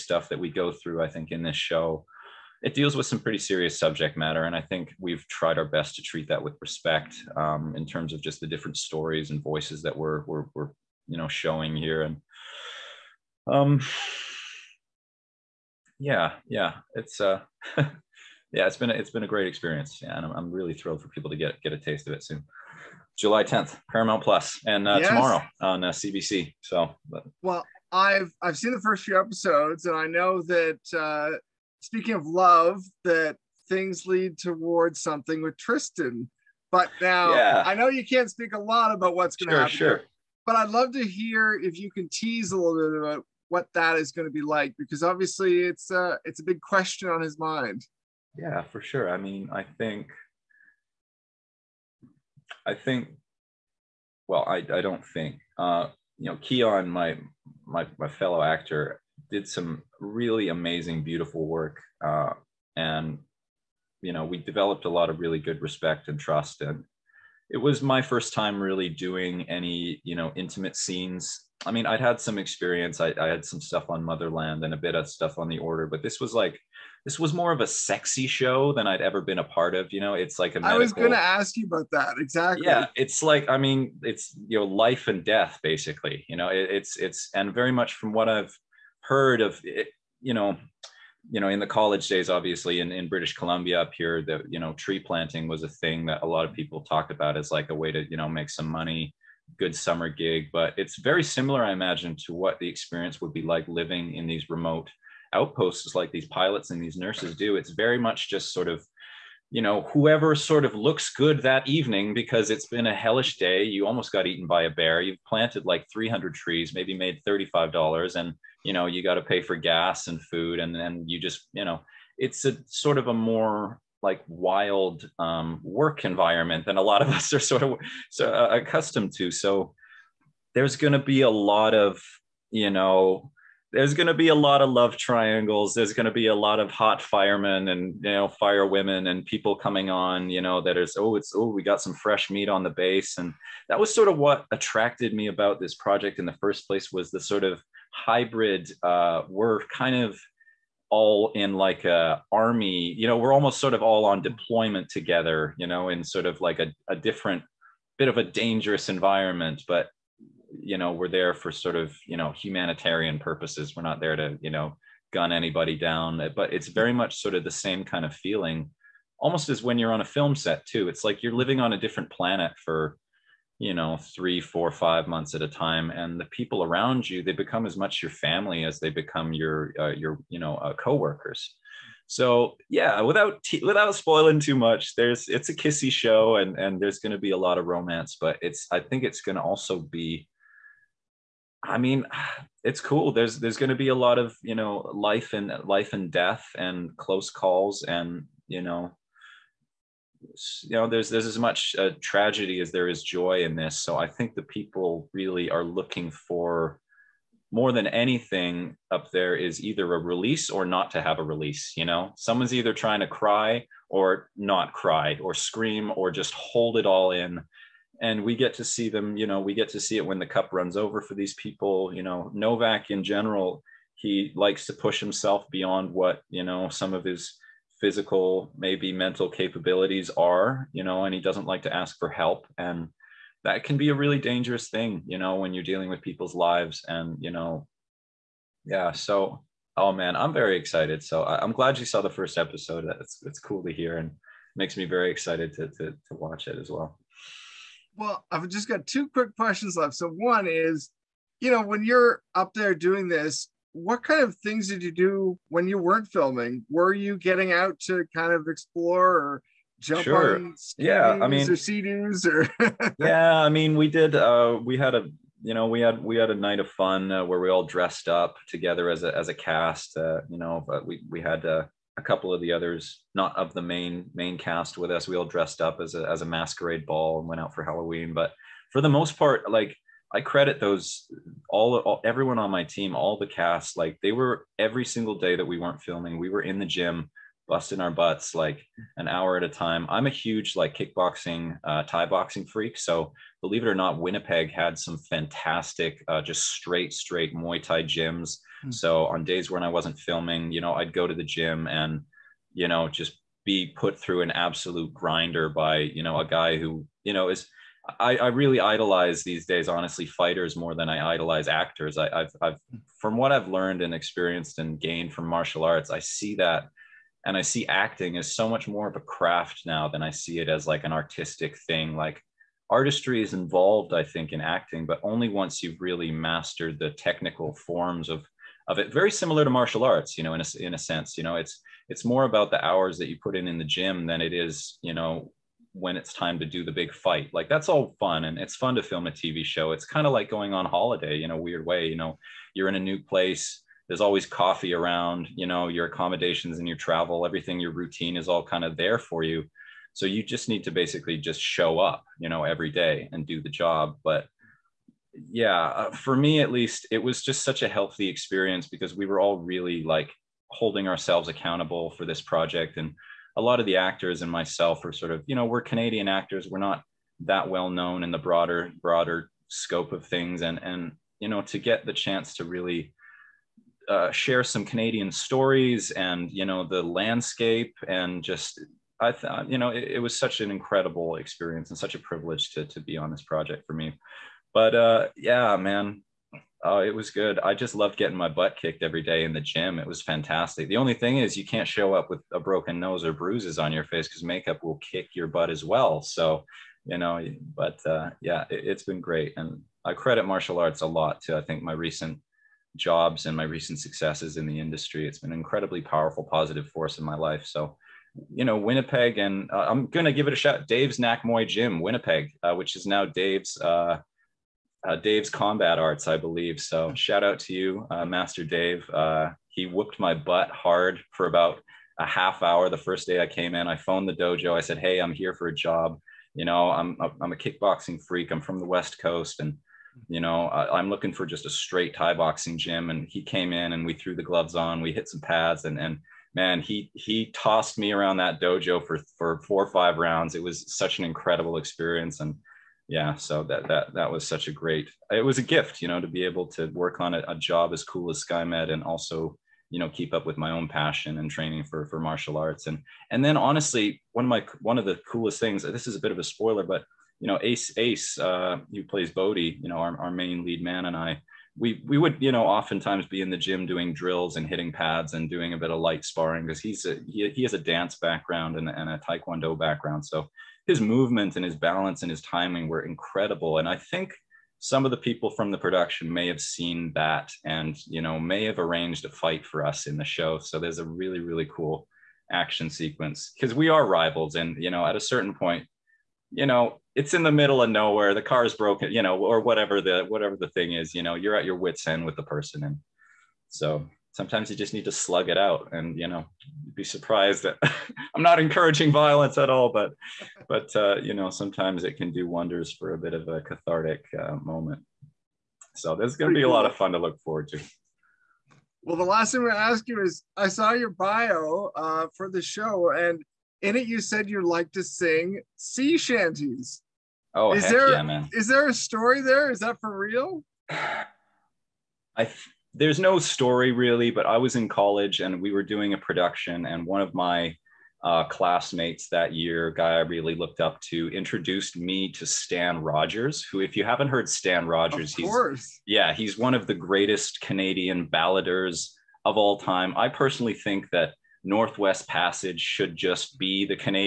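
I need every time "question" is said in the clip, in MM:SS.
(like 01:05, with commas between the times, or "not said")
00:46, 04:09.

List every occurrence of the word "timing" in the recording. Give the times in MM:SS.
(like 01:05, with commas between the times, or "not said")
07:52.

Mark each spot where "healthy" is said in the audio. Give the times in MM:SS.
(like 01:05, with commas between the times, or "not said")
05:57.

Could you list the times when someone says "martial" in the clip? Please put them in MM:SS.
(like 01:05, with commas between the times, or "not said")
05:15, 05:29, 06:40, 07:31.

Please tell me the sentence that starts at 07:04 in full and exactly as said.
I said, "Hey, I'm here for a job.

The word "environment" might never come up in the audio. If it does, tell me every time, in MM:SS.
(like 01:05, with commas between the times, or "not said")
02:06, 02:38.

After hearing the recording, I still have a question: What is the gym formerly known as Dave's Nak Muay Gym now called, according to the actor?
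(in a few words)
Dave's Combat Arts.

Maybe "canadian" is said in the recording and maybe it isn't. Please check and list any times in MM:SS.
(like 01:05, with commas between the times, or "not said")
06:05, 06:14, 08:57.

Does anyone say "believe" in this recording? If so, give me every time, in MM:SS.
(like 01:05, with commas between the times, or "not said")
04:53, 06:56.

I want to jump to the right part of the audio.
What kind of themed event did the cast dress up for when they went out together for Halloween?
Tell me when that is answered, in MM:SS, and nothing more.
04:36.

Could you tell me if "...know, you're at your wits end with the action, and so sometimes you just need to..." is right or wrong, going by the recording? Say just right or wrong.
wrong.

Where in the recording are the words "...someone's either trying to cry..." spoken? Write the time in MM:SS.
03:32.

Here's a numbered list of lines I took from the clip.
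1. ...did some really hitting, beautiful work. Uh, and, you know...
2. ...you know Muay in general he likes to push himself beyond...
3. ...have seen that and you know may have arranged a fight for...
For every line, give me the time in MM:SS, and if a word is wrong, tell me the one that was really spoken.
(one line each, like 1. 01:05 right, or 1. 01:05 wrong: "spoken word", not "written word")
1. 00:59 wrong: "amazing", not "hitting"
2. 03:41 wrong: "Nowak", not "Muay"
3. 07:56 right.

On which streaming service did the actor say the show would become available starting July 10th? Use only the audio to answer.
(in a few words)
Paramount Plus.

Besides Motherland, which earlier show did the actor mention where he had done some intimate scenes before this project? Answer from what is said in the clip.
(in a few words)
The Order.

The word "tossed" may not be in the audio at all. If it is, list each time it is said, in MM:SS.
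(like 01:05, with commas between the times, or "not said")
07:17.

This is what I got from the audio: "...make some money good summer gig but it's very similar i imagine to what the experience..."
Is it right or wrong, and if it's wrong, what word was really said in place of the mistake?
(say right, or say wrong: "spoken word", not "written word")
right.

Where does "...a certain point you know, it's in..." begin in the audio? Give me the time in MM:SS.
08:04.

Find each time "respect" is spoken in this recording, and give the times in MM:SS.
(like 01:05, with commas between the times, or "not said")
00:06, 01:05.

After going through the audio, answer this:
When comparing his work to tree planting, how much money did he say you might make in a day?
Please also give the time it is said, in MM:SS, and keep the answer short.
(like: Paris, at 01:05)
$35, at 01:57.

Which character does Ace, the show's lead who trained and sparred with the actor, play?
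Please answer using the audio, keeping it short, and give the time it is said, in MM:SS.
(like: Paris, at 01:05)
Bodie, at 07:39.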